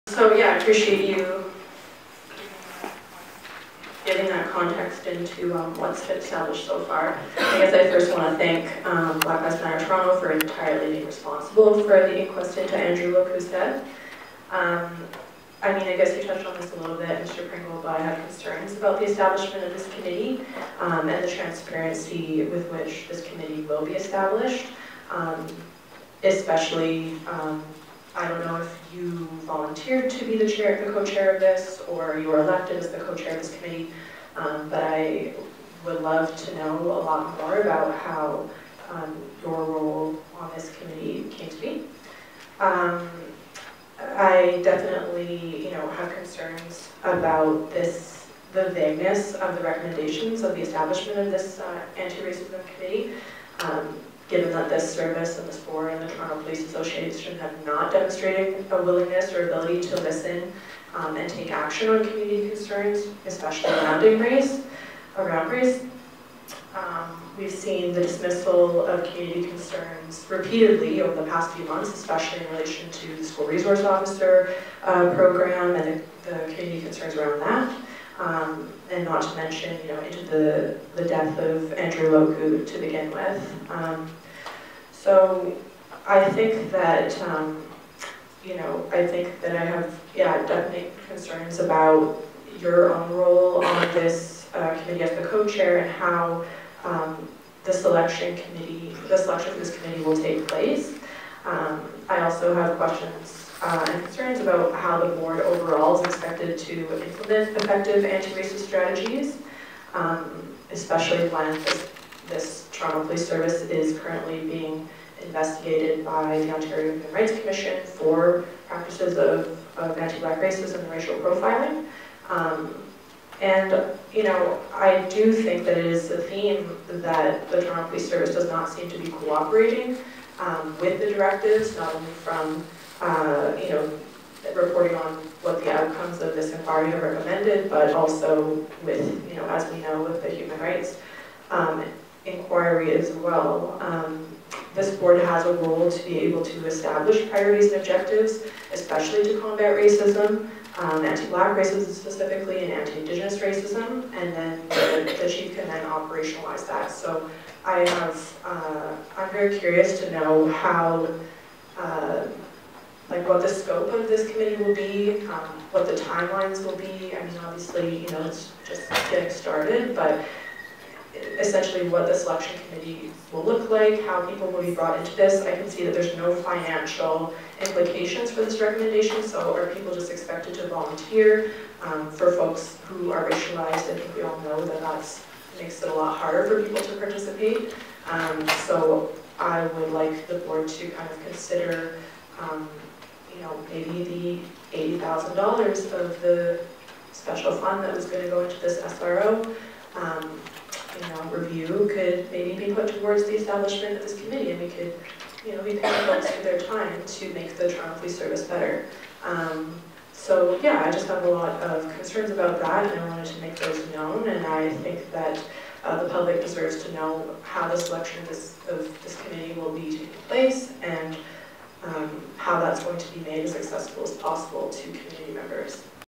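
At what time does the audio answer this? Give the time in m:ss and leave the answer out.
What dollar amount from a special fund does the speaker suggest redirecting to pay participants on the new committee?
3:14.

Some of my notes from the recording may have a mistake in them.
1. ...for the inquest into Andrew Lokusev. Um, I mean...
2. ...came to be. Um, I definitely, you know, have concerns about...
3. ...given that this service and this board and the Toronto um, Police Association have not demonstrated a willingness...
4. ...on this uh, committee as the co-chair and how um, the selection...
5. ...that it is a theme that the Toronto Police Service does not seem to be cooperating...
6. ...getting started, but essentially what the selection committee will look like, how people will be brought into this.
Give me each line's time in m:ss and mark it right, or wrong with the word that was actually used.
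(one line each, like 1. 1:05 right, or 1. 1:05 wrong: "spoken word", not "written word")
1. 0:11 right
2. 0:41 right
3. 0:54 right
4. 1:33 right
5. 2:05 right
6. 2:49 right.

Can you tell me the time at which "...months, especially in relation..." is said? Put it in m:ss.
1:11.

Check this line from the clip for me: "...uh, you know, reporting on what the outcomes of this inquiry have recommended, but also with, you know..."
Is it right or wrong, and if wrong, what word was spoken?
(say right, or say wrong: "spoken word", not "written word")
right.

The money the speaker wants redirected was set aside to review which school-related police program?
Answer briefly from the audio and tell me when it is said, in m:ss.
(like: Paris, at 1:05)
SRO, at 3:18.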